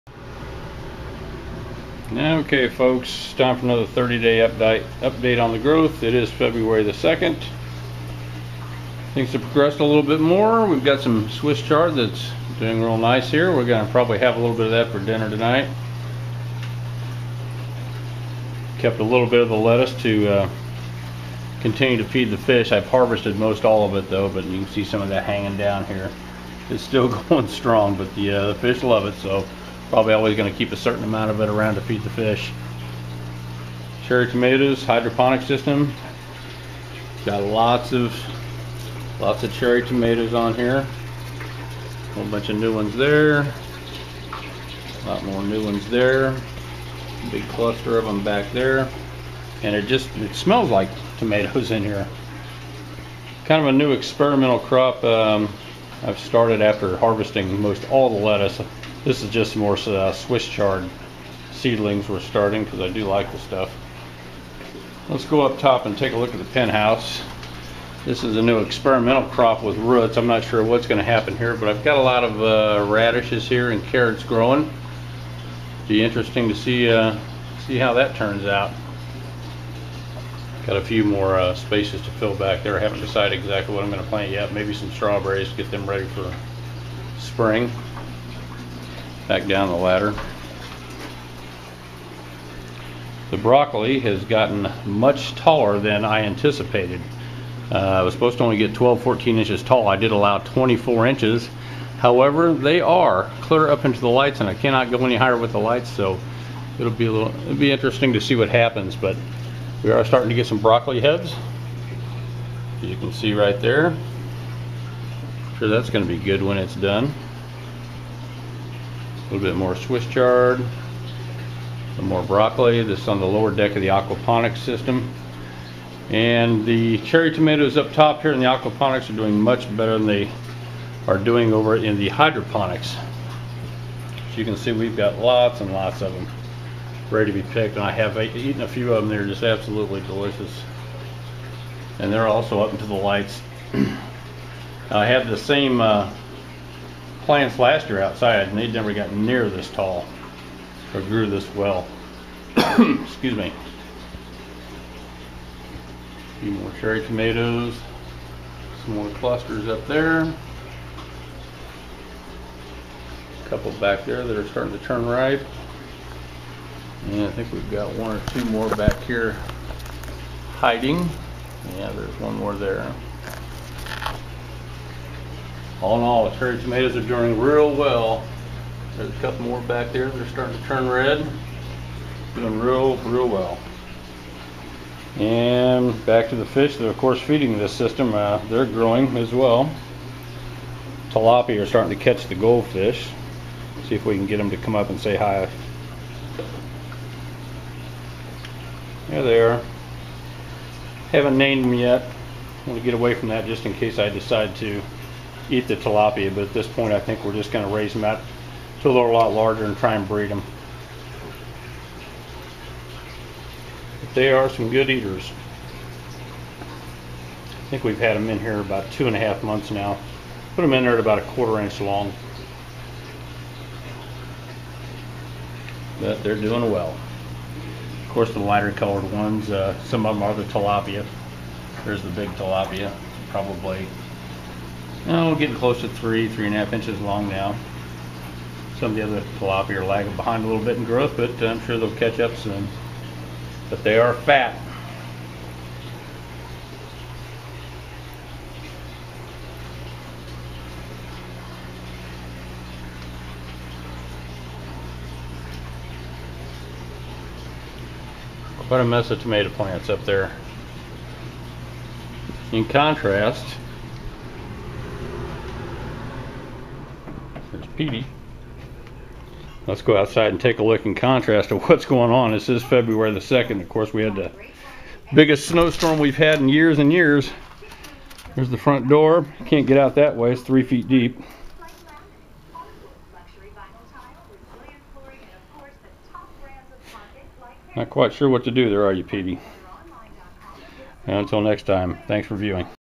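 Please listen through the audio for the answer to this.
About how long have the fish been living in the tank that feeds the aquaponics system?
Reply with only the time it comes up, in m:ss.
3:38.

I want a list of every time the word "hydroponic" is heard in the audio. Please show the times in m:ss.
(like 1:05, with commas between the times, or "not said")
0:34, 2:12.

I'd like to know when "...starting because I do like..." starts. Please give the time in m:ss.
1:02.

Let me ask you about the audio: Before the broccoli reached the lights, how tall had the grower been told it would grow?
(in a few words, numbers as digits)
12 to 14 inches.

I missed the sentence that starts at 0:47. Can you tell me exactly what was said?
Big cluster of them back there.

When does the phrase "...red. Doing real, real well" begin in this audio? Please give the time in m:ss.
3:00.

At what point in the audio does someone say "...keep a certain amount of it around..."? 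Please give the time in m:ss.
0:30.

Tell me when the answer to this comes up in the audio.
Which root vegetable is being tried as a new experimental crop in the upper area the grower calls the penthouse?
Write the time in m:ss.
1:12.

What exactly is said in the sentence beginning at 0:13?
We're going to probably have a little bit of that for dinner tonight.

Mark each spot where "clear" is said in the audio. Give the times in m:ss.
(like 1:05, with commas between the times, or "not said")
1:43.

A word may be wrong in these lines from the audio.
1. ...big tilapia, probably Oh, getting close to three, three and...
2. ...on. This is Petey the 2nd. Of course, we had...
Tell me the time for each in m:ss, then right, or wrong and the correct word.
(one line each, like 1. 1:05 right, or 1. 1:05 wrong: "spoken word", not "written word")
1. 3:52 right
2. 4:32 wrong: "February", not "Petey".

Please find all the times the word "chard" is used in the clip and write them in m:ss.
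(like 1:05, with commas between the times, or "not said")
0:11, 1:00, 2:00.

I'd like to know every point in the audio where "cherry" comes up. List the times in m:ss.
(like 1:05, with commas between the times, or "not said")
0:34, 0:39, 2:06, 2:36, 2:56.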